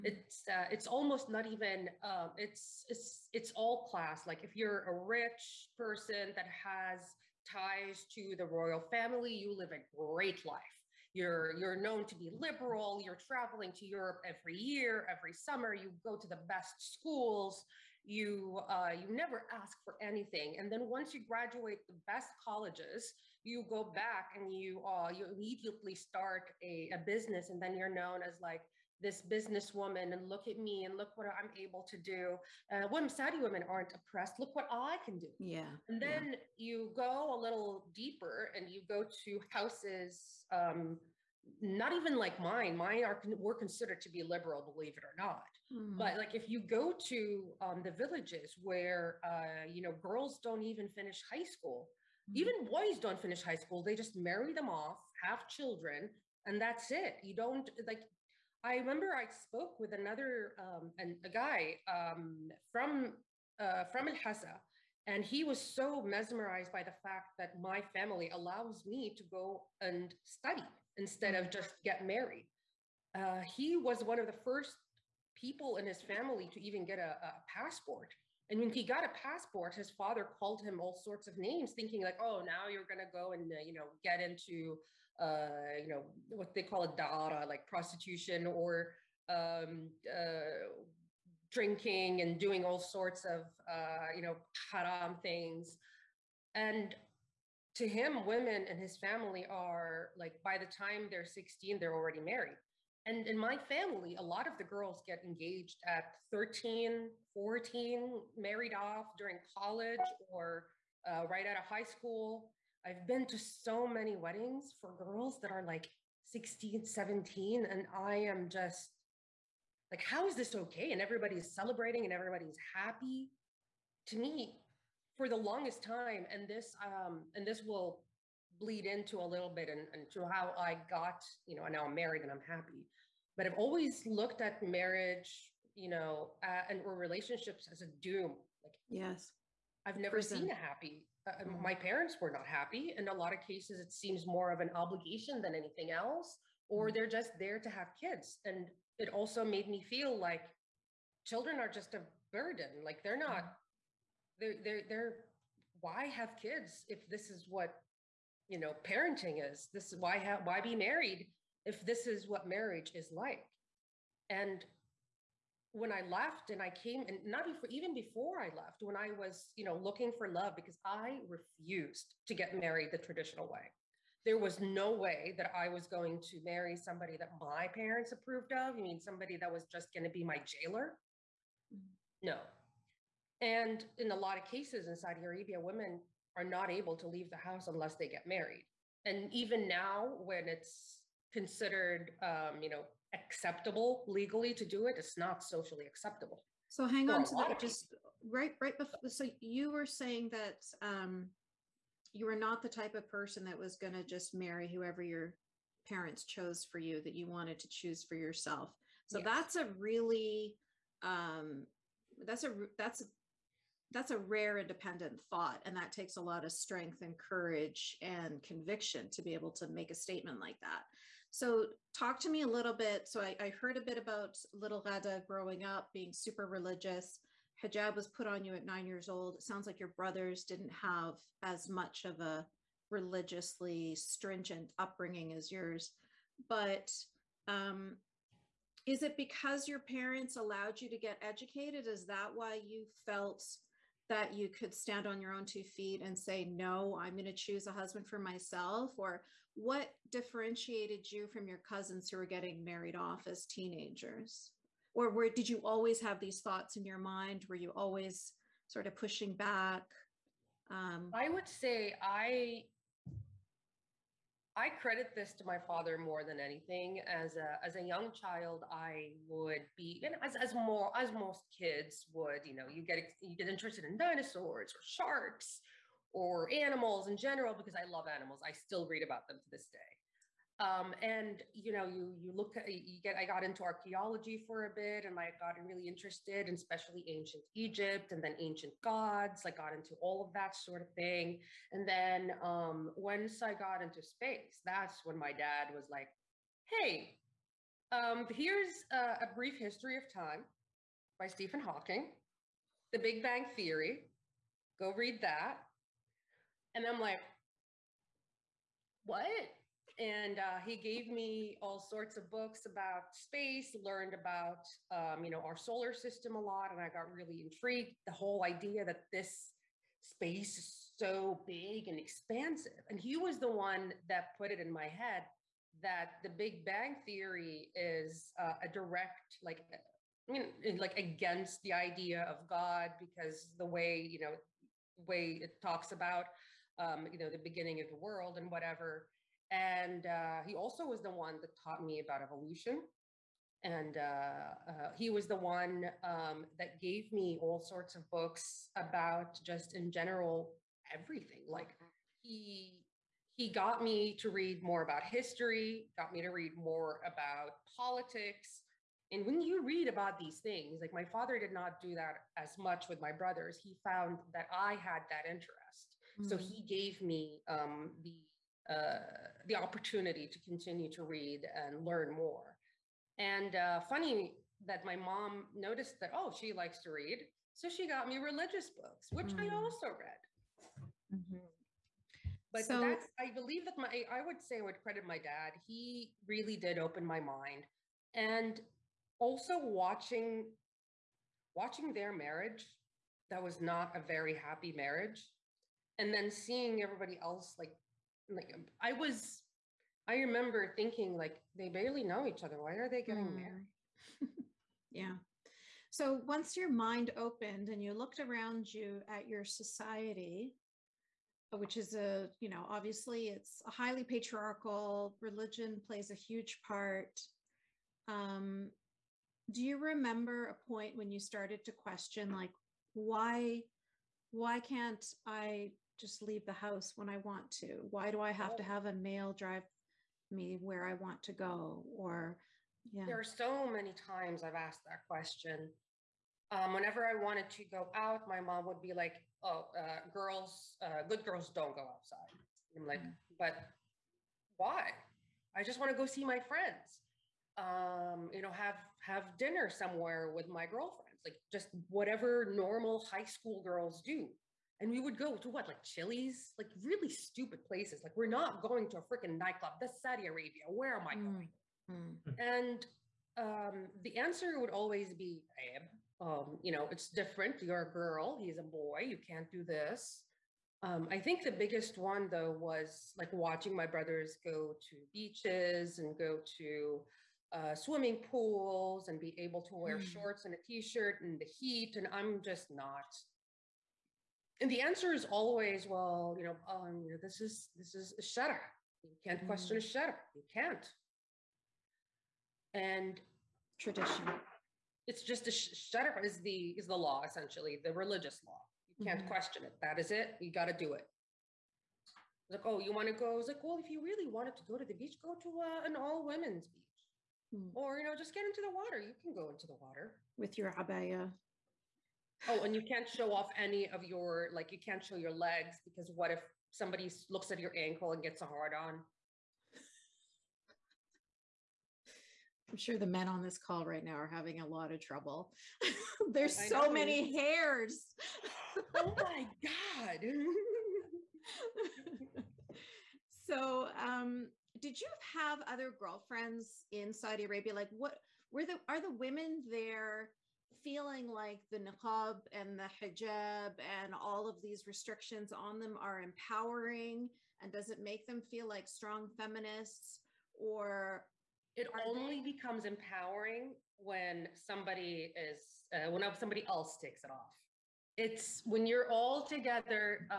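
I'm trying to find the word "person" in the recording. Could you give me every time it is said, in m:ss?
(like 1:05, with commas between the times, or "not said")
0:05, 3:23.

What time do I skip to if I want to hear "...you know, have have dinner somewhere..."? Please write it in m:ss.
7:28.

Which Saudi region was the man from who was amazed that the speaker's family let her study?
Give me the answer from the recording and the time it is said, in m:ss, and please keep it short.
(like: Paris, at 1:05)
Al Hasa, at 1:04.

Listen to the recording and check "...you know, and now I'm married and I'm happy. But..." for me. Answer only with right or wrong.
right.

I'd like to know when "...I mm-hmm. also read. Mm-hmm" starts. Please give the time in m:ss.
6:19.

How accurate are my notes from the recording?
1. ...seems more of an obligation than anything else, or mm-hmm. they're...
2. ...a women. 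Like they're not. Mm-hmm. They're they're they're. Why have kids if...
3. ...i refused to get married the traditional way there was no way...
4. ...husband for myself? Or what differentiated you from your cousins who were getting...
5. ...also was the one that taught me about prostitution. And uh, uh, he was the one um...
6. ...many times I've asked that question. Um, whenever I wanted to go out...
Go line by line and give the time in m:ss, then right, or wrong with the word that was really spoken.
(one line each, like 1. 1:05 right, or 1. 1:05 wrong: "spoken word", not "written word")
1. 2:23 right
2. 2:31 wrong: "burden", not "women"
3. 2:50 right
4. 4:07 right
5. 5:40 wrong: "evolution", not "prostitution"
6. 7:13 right.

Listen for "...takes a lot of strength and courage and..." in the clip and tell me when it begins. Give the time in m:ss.
3:35.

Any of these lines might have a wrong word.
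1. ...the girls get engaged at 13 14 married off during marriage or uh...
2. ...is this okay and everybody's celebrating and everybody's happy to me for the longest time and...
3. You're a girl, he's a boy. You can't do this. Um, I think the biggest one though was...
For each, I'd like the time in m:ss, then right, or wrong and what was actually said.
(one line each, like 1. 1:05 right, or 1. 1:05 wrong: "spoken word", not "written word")
1. 1:44 wrong: "college", not "marriage"
2. 2:00 right
3. 7:47 right.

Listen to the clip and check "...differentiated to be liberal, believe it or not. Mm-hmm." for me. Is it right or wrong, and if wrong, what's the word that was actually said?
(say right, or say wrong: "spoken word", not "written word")
wrong: "considered", not "differentiated".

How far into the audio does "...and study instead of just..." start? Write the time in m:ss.
1:09.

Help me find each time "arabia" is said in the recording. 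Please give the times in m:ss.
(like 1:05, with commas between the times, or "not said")
3:05, 7:40, 8:57.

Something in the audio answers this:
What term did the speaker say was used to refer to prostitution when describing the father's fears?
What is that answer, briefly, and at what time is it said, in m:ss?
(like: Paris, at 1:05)
daara, at 1:26.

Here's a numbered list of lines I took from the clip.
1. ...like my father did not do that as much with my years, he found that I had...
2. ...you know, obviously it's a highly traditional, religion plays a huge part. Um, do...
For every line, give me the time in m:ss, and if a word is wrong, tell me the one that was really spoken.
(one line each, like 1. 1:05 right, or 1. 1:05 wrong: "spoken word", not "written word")
1. 6:00 wrong: "brothers", not "years"
2. 6:52 wrong: "patriarchal", not "traditional".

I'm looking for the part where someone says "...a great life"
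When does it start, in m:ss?
0:09.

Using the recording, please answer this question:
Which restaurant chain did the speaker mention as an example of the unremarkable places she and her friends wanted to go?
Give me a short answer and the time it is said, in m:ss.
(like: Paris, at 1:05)
Chili's, at 7:35.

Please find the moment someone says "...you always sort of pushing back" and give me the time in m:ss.
4:17.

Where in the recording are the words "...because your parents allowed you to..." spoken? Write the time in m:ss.
3:59.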